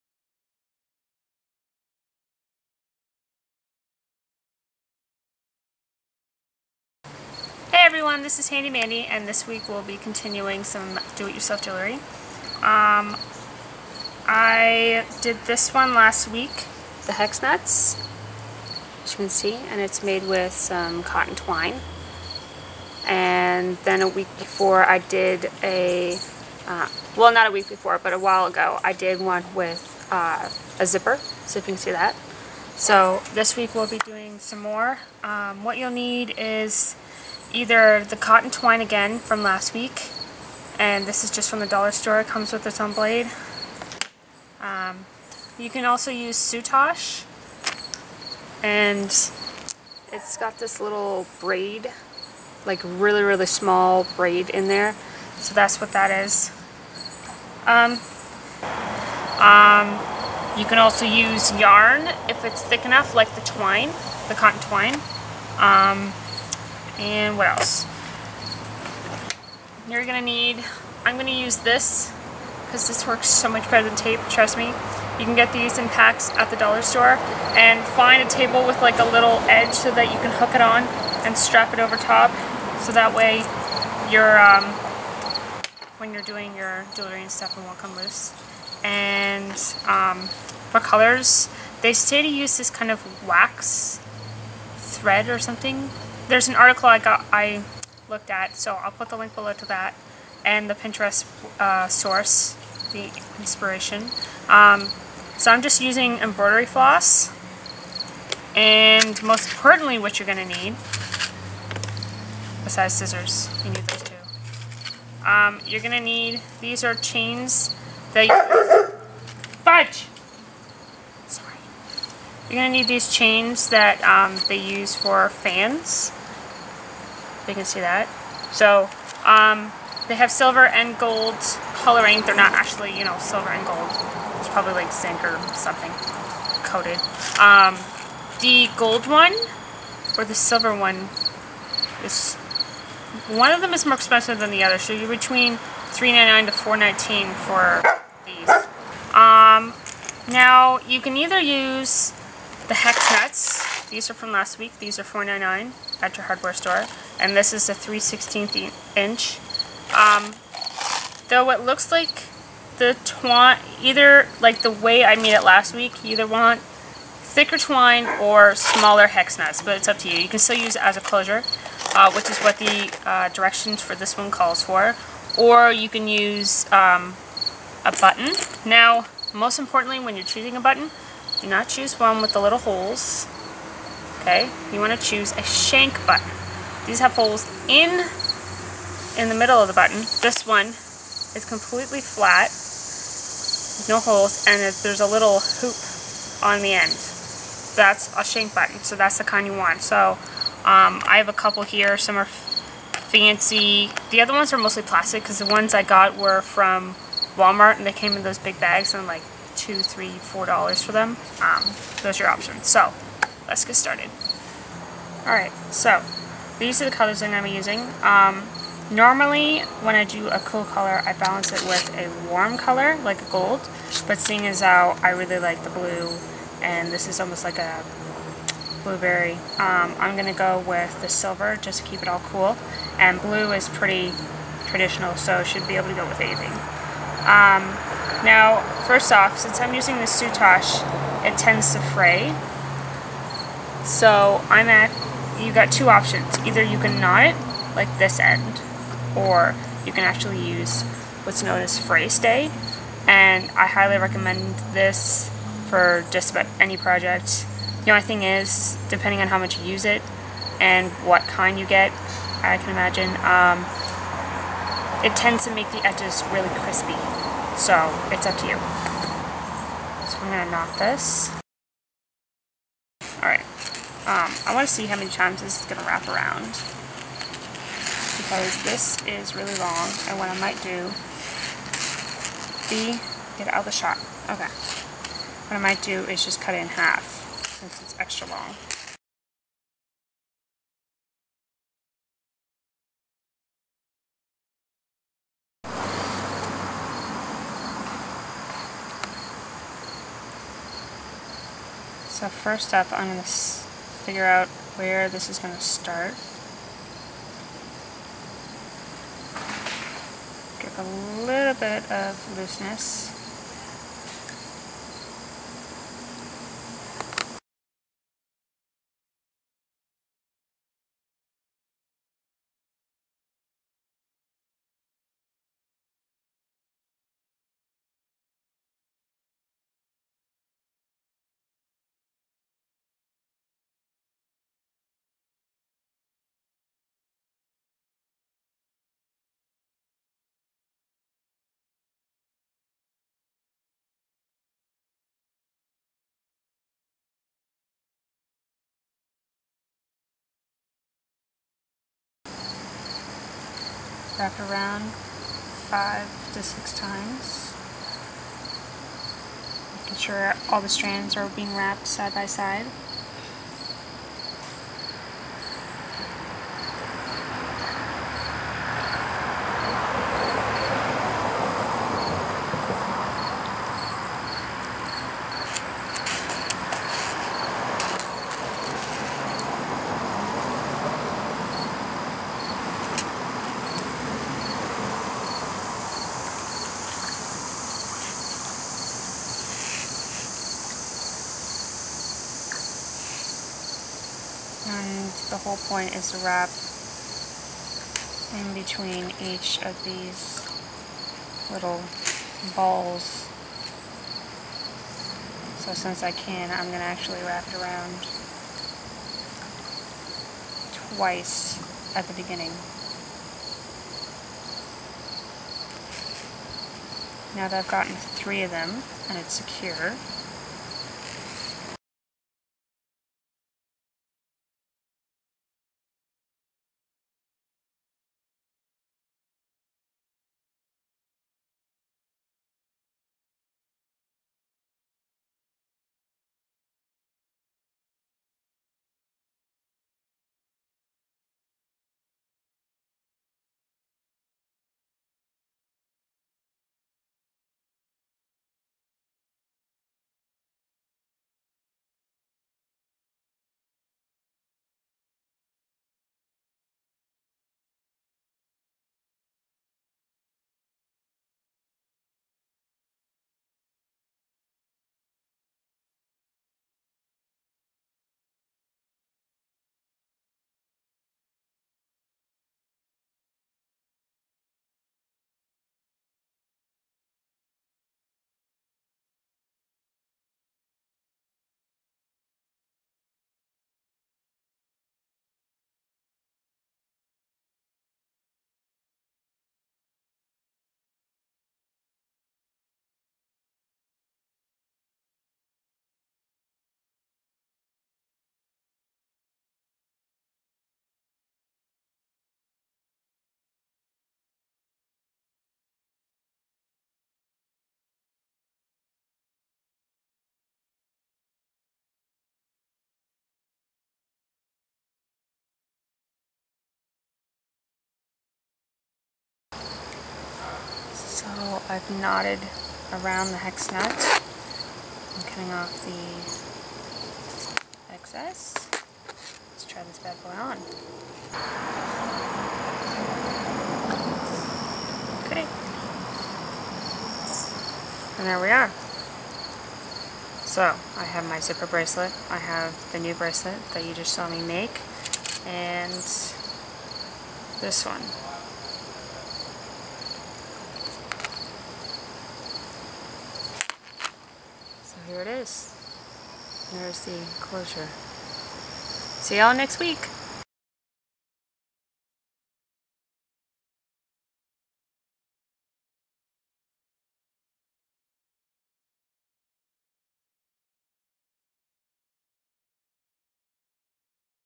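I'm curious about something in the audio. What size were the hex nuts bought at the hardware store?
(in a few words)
3/16 inch.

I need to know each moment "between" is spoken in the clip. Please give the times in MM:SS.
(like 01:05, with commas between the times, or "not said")
02:25, 06:38.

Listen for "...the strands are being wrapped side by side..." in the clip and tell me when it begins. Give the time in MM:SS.
06:00.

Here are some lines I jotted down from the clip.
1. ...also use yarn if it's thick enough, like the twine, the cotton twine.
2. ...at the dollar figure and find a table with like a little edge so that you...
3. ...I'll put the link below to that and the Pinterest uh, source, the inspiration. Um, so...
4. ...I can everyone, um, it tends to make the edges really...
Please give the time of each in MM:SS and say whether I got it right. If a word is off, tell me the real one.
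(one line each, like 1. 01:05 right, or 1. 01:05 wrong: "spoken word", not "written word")
1. 01:00 right
2. 01:16 wrong: "store", not "figure"
3. 01:38 right
4. 04:22 wrong: "imagine", not "everyone".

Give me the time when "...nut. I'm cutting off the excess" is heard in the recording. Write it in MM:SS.
08:43.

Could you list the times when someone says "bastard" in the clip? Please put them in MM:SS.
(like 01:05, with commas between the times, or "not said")
not said.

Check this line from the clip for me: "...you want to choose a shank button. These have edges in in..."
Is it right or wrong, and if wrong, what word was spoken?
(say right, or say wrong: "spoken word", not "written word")
wrong: "holes", not "edges".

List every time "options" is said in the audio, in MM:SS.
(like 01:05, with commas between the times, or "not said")
03:32, 04:05.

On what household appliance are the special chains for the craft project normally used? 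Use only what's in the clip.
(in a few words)
Fans.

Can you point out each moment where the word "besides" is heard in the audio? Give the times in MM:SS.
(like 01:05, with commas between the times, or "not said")
01:52.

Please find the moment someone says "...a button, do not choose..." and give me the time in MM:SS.
03:00.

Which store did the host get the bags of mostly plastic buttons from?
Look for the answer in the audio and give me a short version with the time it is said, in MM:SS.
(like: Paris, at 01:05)
Walmart, at 03:27.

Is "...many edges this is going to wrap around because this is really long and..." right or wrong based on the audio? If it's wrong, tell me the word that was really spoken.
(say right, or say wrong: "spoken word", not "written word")
wrong: "times", not "edges".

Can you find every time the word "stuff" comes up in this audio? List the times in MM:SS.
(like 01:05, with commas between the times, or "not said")
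01:27.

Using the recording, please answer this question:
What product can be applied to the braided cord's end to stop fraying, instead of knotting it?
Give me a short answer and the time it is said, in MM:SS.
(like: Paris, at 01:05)
Fray stay, at 04:11.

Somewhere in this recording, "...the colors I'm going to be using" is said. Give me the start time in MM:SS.
03:36.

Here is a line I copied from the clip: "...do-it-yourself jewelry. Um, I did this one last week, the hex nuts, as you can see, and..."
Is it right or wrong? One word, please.
right.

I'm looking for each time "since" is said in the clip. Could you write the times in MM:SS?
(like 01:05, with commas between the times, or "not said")
03:59, 04:47, 06:45.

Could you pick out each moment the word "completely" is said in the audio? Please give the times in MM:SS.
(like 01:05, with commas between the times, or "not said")
03:11.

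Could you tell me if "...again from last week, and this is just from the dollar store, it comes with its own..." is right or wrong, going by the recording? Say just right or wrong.
right.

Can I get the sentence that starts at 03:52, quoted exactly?
And blue is pretty traditional, so should be able to go with anything.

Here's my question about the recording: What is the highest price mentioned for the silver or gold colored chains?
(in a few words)
$4.19.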